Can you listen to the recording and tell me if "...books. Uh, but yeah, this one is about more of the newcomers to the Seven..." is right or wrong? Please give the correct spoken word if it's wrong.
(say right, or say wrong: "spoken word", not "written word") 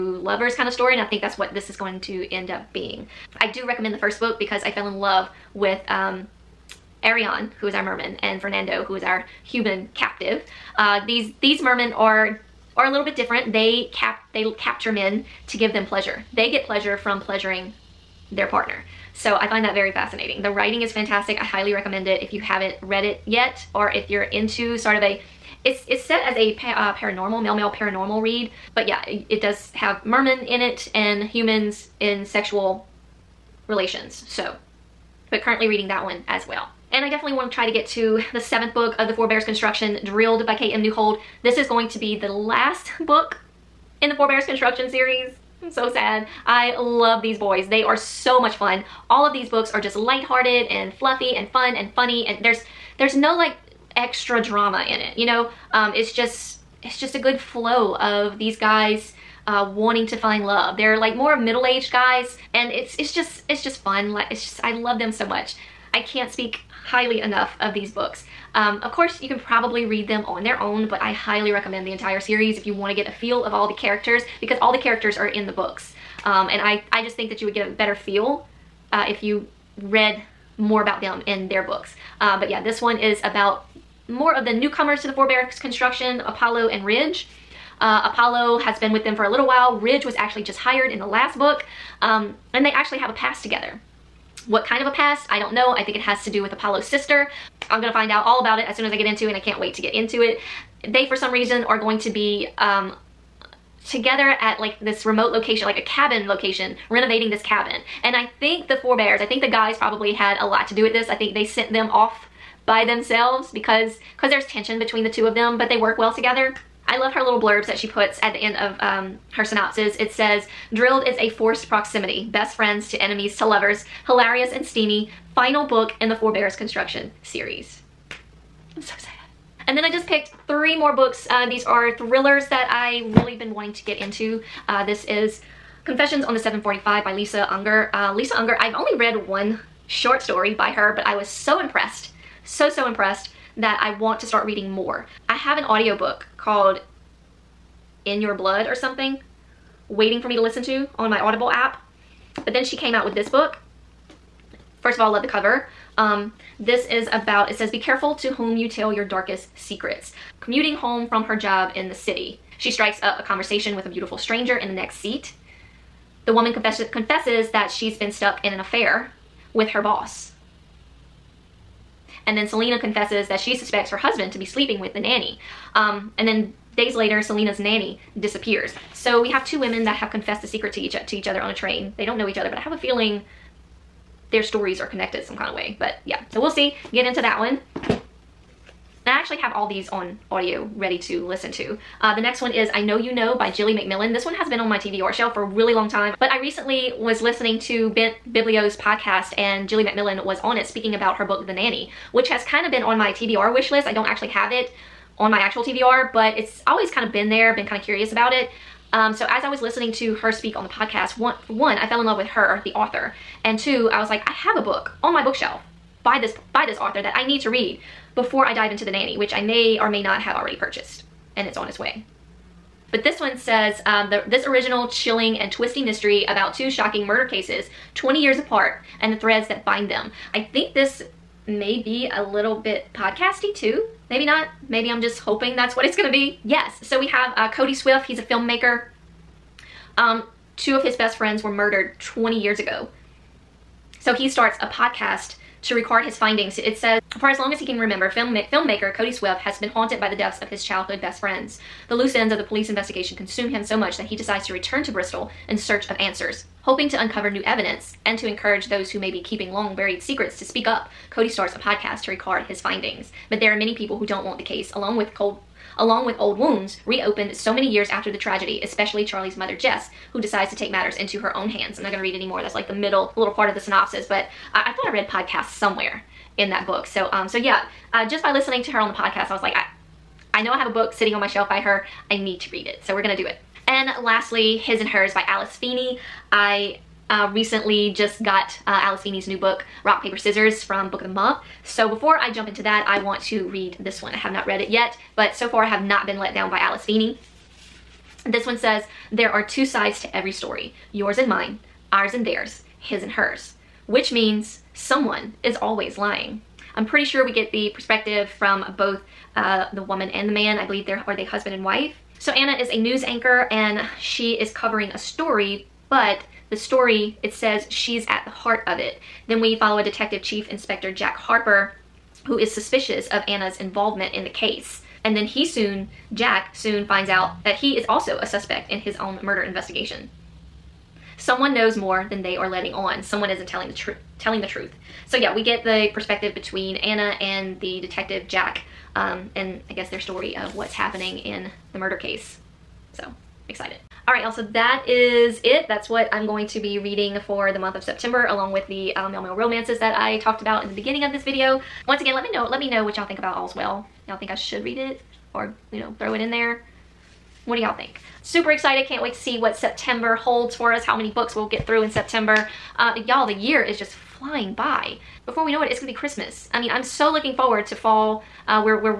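wrong: "Four", not "Seven".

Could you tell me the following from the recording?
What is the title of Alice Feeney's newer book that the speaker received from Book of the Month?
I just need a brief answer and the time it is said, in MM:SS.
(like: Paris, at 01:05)
Rock, Paper, Scissors, at 04:49.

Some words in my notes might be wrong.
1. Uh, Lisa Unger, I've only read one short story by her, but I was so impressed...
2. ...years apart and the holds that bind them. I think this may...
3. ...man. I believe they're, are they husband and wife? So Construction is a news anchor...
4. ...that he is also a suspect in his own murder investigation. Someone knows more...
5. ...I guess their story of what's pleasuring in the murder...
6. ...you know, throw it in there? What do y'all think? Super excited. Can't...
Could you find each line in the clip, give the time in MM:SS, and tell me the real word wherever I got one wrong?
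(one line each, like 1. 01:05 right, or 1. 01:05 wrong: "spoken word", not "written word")
1. 02:17 right
2. 03:48 wrong: "threads", not "holds"
3. 05:10 wrong: "Anna", not "Construction"
4. 05:27 right
5. 05:39 wrong: "happening", not "pleasuring"
6. 05:55 right.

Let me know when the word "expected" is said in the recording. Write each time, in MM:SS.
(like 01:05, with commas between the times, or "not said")
not said.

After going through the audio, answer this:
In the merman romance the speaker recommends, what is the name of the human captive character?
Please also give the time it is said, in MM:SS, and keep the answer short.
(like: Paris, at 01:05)
Fernando, at 00:08.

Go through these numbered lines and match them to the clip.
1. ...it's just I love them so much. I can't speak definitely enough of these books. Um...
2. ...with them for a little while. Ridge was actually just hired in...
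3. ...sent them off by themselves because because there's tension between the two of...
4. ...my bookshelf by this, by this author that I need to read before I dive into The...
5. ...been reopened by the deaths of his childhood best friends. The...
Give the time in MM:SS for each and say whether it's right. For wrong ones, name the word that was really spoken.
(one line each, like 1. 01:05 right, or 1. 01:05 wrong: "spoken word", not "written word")
1. 01:04 wrong: "highly", not "definitely"
2. 01:28 right
3. 01:51 right
4. 03:35 right
5. 04:09 wrong: "haunted", not "reopened".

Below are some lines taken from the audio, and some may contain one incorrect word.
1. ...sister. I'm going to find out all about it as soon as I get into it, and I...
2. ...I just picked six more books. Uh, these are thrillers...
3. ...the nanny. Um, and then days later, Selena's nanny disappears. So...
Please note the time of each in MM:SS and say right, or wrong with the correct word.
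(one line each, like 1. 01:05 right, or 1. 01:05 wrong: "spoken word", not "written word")
1. 01:36 right
2. 02:09 wrong: "three", not "six"
3. 02:54 right.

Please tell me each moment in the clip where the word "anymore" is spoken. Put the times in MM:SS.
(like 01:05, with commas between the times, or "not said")
04:32.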